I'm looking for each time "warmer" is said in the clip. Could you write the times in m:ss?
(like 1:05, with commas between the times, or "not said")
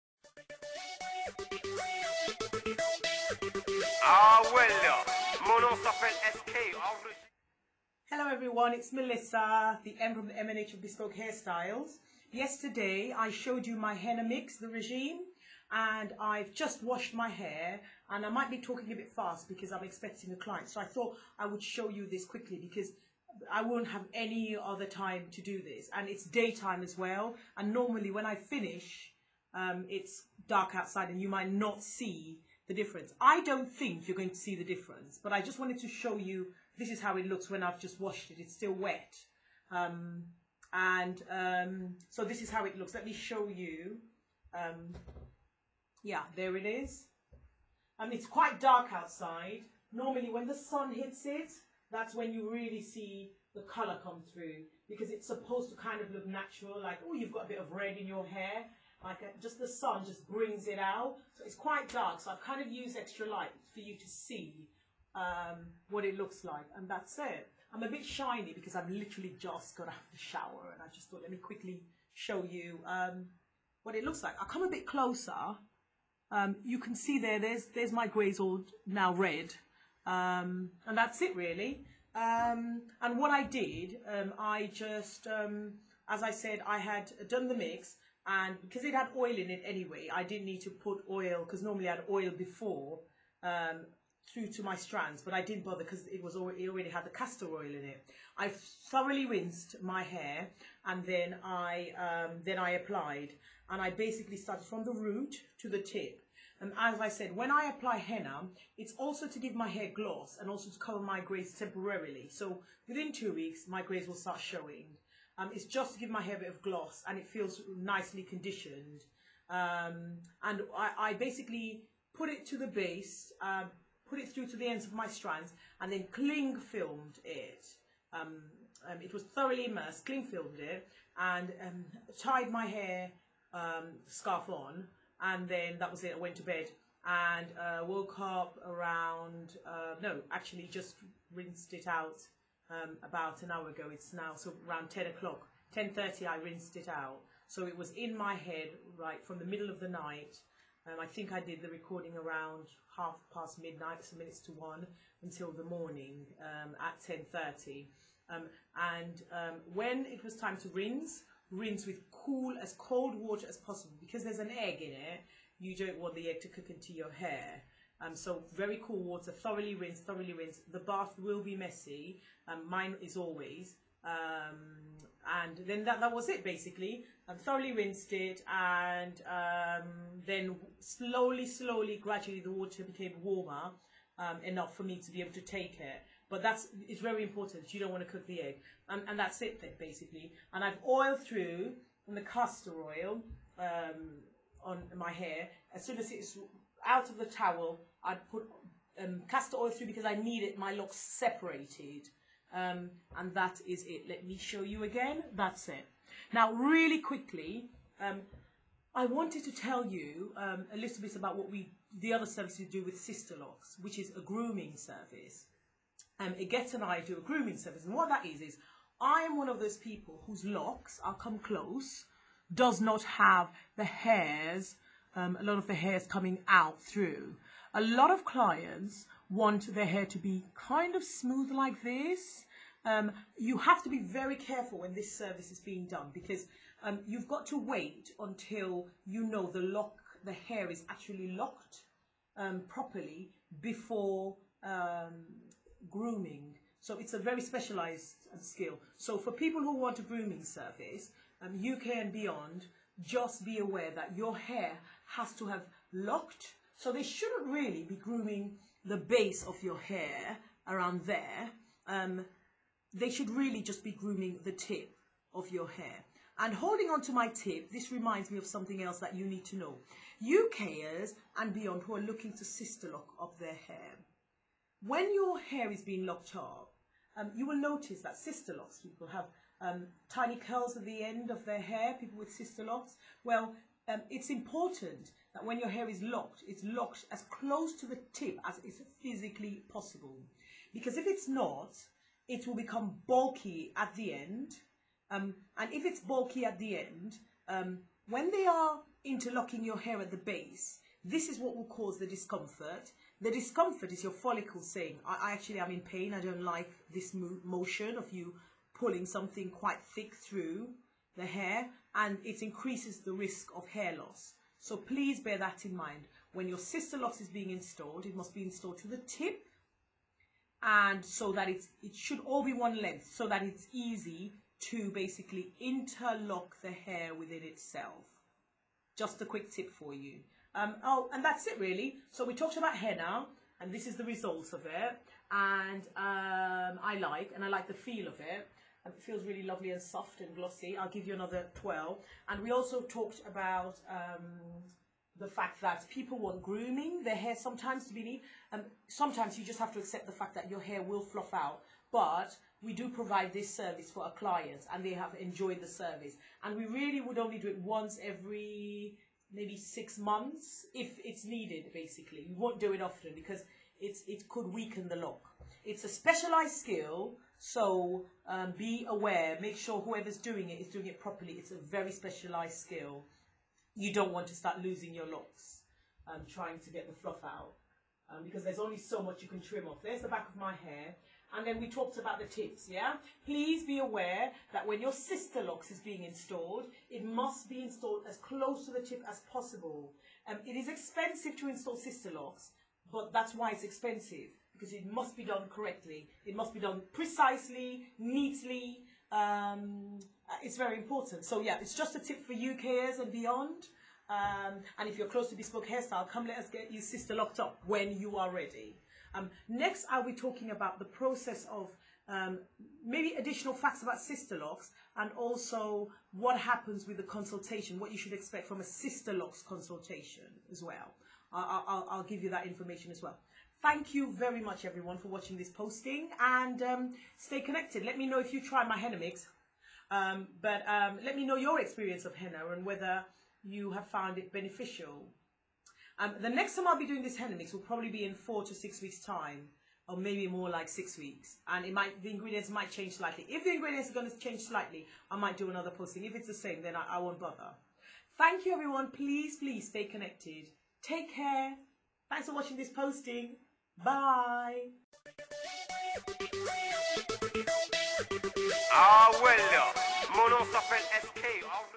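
3:03.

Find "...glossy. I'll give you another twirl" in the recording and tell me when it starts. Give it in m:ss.
5:40.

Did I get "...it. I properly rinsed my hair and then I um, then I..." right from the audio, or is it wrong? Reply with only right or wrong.
wrong.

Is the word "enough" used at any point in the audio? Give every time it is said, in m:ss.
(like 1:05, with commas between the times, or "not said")
3:04.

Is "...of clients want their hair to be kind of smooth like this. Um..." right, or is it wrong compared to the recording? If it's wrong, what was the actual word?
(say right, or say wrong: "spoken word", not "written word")
right.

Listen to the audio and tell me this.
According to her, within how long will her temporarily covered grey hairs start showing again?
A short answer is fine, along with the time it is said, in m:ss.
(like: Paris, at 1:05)
Two weeks, at 1:52.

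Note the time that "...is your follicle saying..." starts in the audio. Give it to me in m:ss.
5:03.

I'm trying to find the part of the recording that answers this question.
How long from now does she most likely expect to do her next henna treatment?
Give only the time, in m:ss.
7:20.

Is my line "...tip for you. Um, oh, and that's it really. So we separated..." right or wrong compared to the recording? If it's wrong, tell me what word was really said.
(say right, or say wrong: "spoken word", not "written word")
wrong: "talked", not "separated".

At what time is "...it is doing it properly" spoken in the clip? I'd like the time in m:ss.
6:10.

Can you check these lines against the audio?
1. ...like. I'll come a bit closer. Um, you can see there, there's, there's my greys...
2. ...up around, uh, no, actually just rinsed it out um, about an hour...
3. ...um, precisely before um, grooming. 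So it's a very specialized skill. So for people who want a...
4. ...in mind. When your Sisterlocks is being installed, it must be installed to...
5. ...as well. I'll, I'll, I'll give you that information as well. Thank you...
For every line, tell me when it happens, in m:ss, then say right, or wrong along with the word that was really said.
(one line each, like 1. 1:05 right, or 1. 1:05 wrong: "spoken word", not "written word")
1. 1:14 right
2. 2:18 right
3. 4:02 wrong: "properly", not "precisely"
4. 5:15 right
5. 7:00 right.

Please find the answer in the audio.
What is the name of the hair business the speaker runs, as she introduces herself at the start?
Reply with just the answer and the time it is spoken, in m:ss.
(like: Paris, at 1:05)
Bespoke Hairstyles, at 0:10.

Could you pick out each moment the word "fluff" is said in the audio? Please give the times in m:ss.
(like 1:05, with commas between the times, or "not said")
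5:51, 6:16.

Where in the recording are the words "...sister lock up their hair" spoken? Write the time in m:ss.
4:32.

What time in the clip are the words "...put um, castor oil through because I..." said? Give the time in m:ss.
3:18.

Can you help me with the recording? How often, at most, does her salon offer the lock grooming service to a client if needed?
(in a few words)
Every 6 months.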